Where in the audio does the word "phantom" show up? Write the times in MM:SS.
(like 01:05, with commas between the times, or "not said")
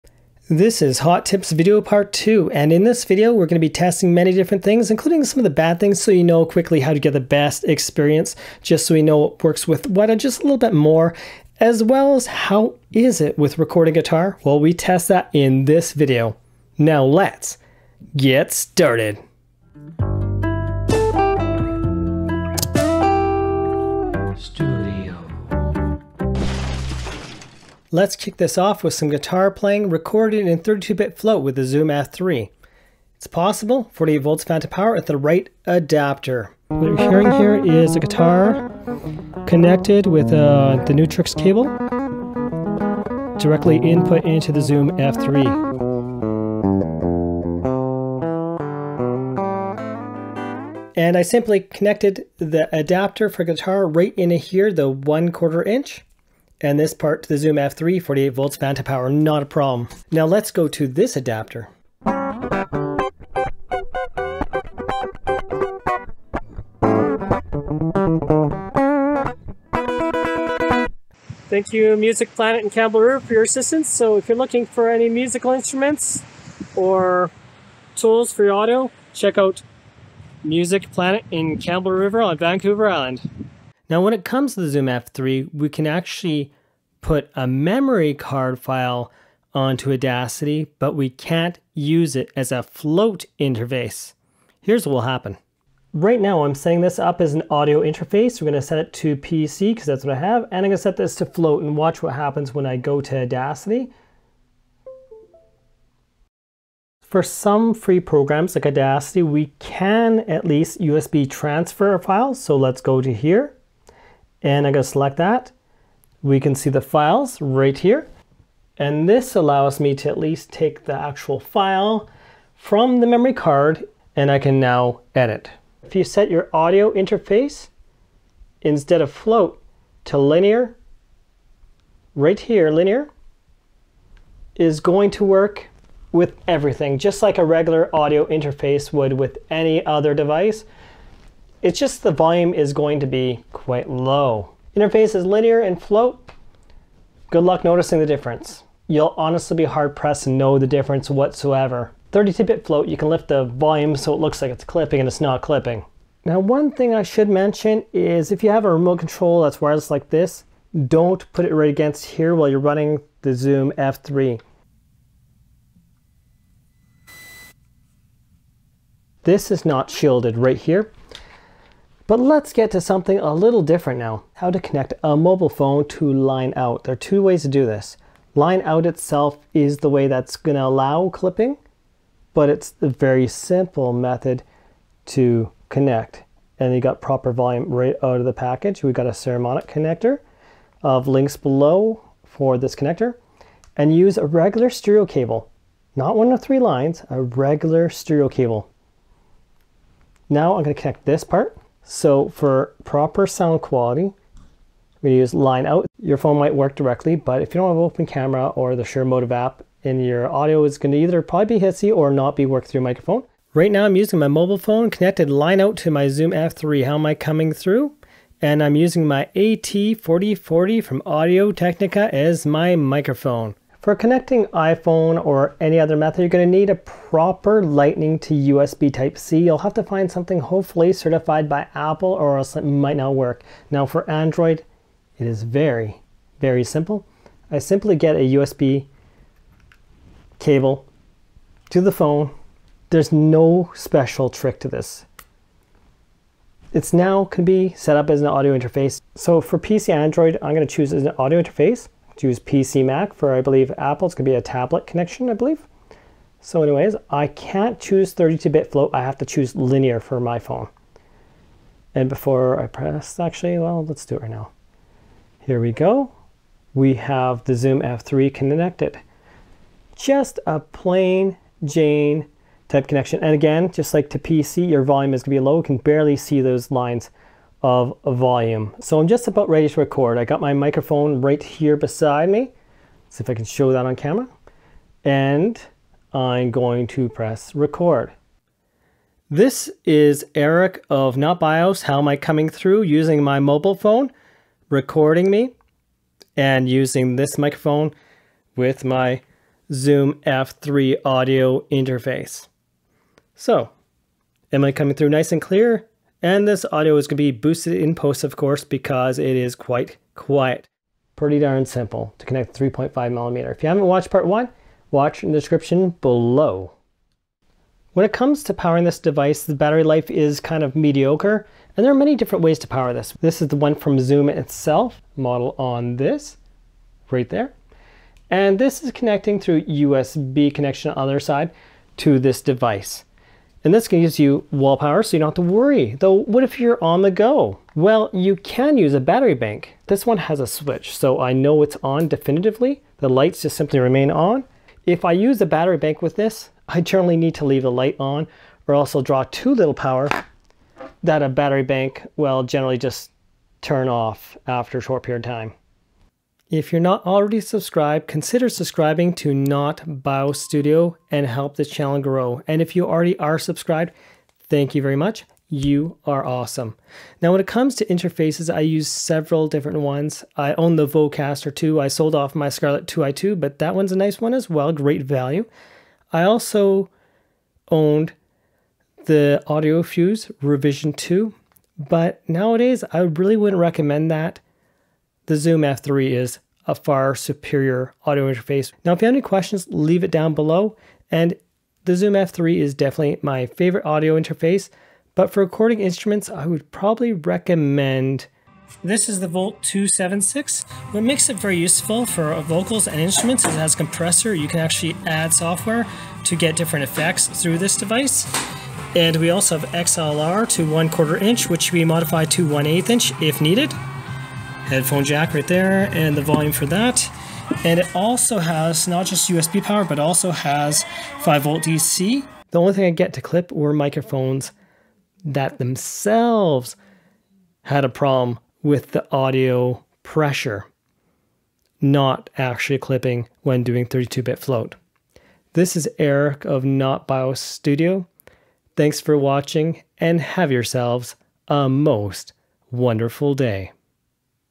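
00:34, 00:58.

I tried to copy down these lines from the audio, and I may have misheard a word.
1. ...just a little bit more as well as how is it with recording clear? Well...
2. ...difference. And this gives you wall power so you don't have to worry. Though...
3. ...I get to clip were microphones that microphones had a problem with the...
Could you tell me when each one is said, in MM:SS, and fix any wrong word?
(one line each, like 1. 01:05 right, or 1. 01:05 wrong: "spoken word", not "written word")
1. 00:10 wrong: "guitar", not "clear"
2. 05:32 wrong: "device", not "difference"
3. 07:02 wrong: "themselves", not "microphones".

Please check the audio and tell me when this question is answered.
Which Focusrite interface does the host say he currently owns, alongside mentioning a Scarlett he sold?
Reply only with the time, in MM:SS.
06:10.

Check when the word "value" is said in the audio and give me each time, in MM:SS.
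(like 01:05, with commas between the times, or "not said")
06:15.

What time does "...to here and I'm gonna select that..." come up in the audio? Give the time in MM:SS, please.
01:53.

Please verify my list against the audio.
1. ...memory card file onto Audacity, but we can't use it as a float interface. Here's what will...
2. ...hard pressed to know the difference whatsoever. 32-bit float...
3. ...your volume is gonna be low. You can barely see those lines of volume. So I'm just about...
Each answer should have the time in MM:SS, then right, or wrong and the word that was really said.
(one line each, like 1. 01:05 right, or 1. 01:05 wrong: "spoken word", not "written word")
1. 01:27 right
2. 02:29 right
3. 04:34 right.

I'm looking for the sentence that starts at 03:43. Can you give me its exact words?
For connecting iPhone or any other method, you're going to need a proper lightning to USB Type-C.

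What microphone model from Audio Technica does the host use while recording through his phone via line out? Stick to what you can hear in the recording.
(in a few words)
AT4040.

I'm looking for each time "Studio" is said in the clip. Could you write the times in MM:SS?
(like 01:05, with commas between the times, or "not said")
06:00, 07:17.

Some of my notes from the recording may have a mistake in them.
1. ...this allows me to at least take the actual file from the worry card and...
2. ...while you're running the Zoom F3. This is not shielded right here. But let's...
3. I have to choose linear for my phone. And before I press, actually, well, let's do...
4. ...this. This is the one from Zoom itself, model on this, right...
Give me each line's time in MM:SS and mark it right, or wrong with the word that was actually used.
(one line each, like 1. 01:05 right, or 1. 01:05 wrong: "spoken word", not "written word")
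1. 01:59 wrong: "memory", not "worry"
2. 02:42 right
3. 04:18 right
4. 05:22 right.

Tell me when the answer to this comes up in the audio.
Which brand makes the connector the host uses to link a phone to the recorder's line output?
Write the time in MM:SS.
03:09.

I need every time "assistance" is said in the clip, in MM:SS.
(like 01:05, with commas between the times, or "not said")
01:13.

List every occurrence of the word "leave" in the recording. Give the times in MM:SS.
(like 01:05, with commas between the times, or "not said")
05:47, 06:29.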